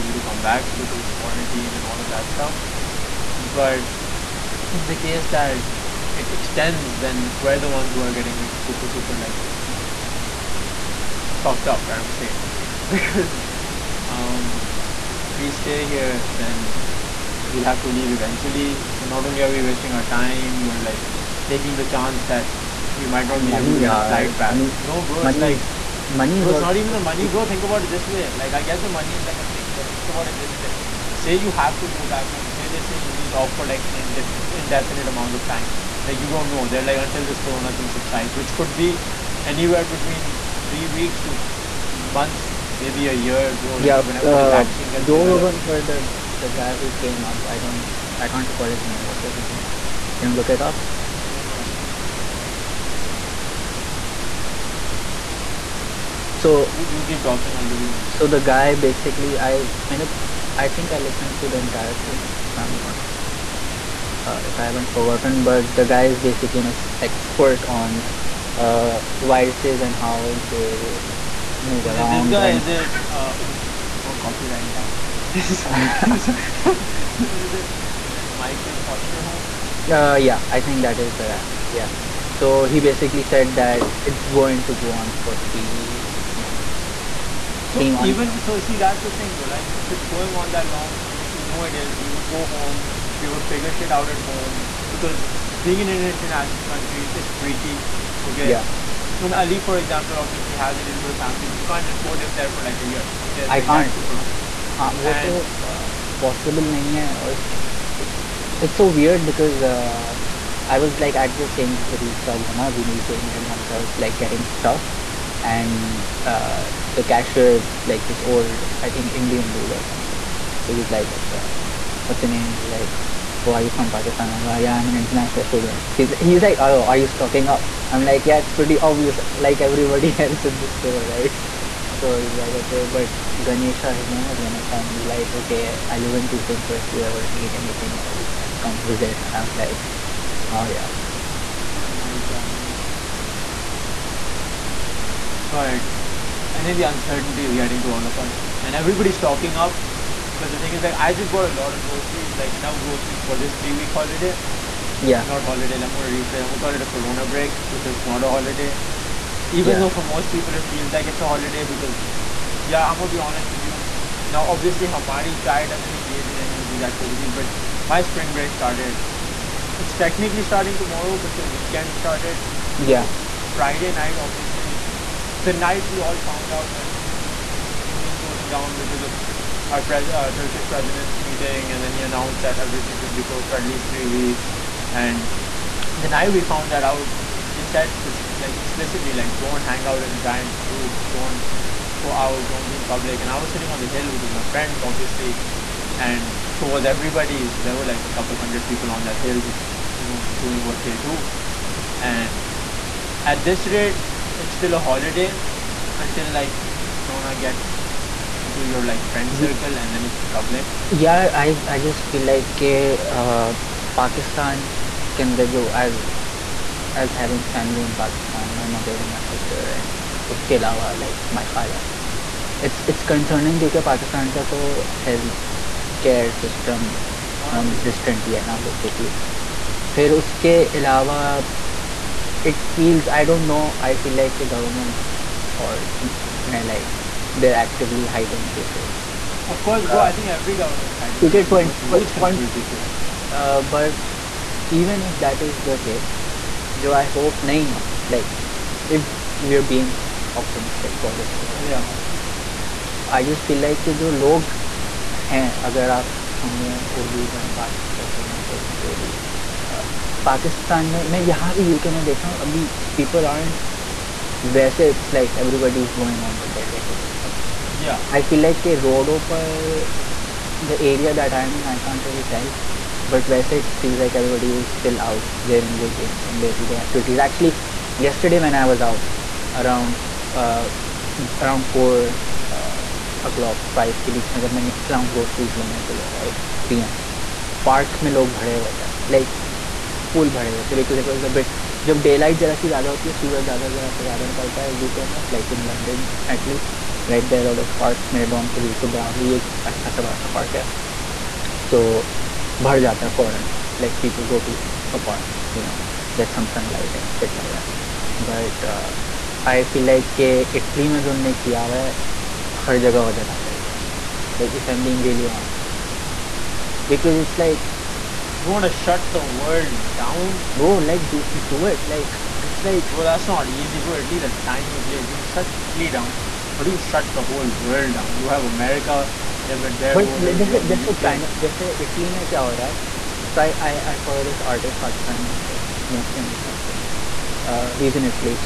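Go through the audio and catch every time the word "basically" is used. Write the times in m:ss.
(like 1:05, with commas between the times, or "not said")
0:58, 1:06, 1:22, 3:48.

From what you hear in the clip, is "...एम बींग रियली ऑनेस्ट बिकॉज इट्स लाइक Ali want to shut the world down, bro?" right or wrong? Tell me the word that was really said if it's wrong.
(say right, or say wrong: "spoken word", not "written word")
wrong: "You", not "Ali".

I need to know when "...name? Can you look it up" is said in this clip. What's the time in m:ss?
0:49.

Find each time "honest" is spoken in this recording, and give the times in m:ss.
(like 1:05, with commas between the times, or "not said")
2:43.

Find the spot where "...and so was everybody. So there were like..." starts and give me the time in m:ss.
3:15.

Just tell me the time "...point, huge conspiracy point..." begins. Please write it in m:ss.
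4:01.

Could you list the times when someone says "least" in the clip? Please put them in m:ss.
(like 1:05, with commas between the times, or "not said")
3:03, 5:24.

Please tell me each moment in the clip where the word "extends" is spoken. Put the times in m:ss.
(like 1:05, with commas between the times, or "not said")
0:06.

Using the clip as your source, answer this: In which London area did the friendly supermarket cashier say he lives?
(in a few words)
Tooting.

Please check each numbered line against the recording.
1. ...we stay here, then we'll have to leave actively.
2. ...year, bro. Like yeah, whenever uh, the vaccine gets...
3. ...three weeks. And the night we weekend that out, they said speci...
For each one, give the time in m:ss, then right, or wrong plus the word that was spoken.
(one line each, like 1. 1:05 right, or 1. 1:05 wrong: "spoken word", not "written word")
1. 0:15 wrong: "eventually", not "actively"
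2. 0:43 right
3. 3:03 wrong: "found", not "weekend".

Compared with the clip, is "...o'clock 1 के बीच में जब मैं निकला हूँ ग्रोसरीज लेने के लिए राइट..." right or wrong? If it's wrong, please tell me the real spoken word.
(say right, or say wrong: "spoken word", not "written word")
wrong: "5", not "1".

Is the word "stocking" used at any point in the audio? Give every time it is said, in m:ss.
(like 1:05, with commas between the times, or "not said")
2:07, 2:29.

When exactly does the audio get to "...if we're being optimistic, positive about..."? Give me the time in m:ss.
4:08.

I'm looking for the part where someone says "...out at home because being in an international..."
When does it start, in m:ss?
1:33.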